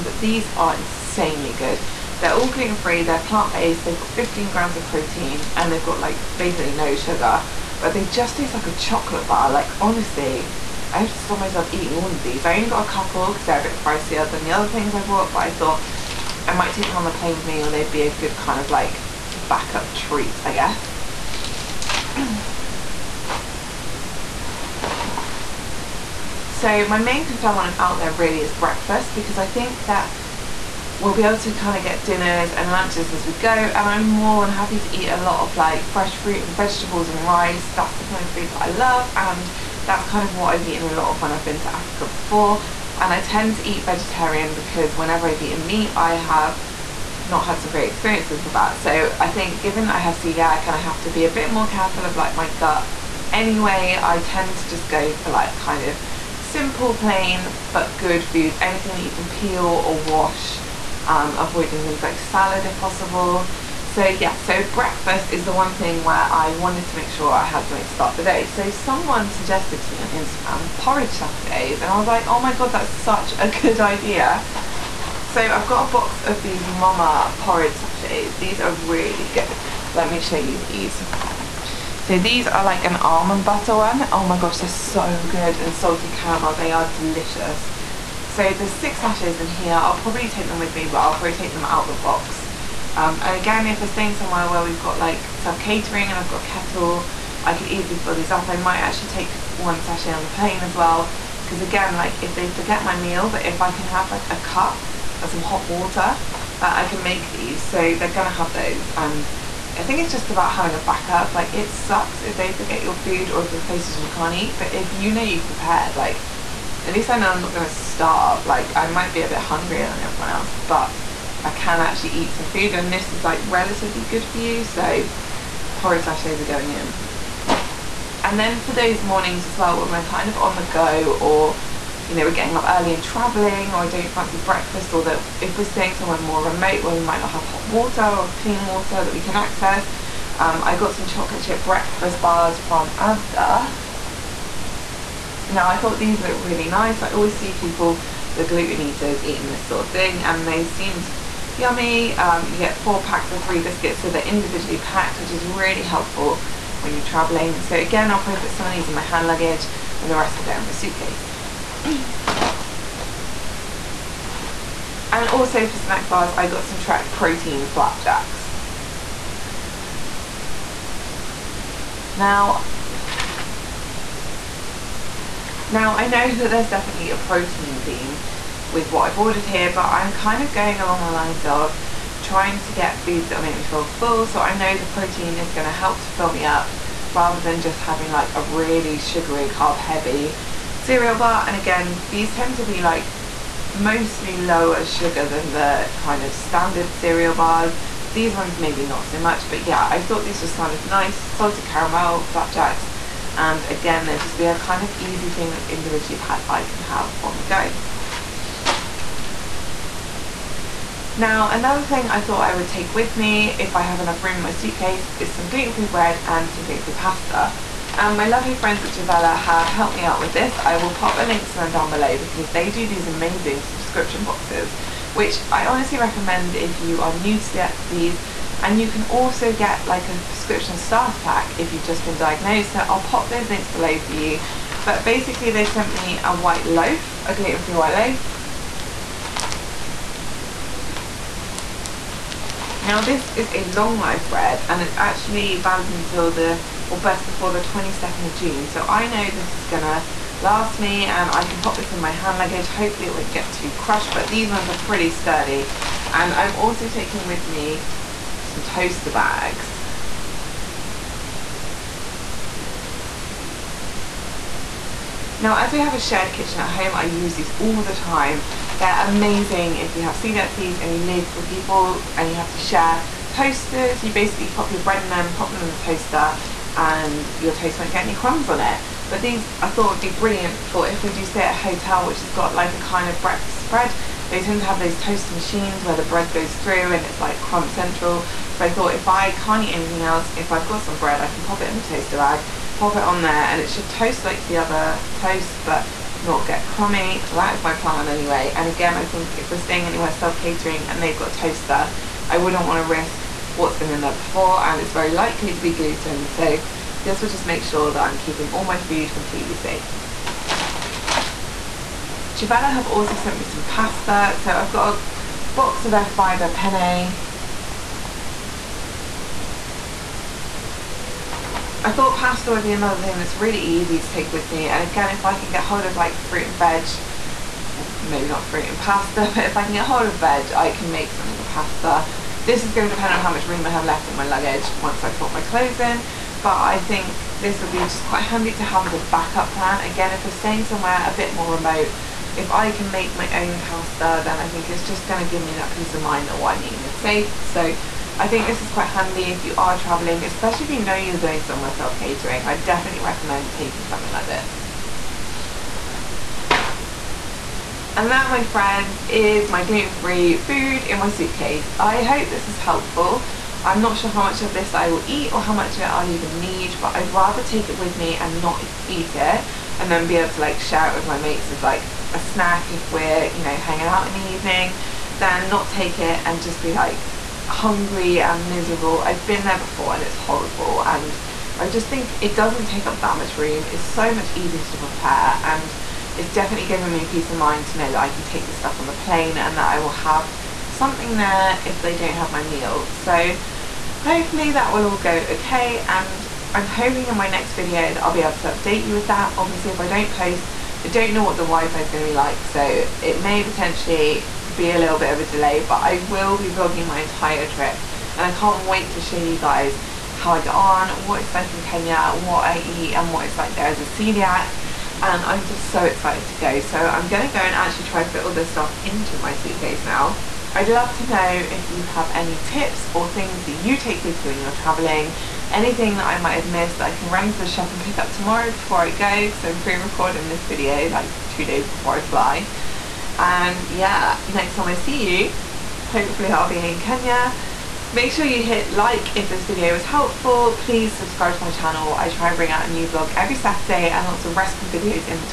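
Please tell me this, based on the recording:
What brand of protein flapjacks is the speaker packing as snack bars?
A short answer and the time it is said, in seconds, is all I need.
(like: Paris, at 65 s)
Trek, at 166 s.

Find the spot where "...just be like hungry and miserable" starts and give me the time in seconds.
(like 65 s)
376 s.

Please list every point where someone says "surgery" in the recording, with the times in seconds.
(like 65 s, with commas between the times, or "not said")
not said.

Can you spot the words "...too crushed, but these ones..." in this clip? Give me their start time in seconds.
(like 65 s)
253 s.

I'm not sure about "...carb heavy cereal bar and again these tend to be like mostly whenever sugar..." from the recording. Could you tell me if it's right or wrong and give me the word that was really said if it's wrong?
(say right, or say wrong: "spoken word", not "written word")
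wrong: "lower", not "whenever".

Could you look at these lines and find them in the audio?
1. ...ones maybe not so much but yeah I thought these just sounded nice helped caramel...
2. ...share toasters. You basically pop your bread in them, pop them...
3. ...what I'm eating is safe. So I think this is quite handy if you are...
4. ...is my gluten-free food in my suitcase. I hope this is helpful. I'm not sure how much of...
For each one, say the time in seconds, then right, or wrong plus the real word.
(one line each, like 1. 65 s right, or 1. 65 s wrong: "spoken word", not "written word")
1. 198 s wrong: "salted", not "helped"
2. 272 s right
3. 346 s right
4. 359 s right.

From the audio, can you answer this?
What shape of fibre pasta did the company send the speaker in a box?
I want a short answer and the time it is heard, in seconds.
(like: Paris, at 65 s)
Penne, at 316 s.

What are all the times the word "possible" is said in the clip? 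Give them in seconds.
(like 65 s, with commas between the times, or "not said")
62 s.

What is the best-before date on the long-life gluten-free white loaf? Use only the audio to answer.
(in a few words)
22nd of June.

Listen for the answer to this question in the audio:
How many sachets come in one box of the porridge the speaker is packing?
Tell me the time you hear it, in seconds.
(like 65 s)
88 s.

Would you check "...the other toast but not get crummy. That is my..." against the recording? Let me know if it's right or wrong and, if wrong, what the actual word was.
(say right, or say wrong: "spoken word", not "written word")
right.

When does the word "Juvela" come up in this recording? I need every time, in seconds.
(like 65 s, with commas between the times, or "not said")
218 s, 312 s.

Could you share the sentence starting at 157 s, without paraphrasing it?
So again I'll probably put some of these in my hand luggage and the rest will go in my suitcase.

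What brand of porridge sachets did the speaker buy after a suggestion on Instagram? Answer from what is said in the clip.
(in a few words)
MOMA.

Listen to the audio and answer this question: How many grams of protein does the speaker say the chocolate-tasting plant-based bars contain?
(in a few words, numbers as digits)
15.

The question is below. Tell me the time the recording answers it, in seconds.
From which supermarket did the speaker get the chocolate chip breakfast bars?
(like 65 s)
142 s.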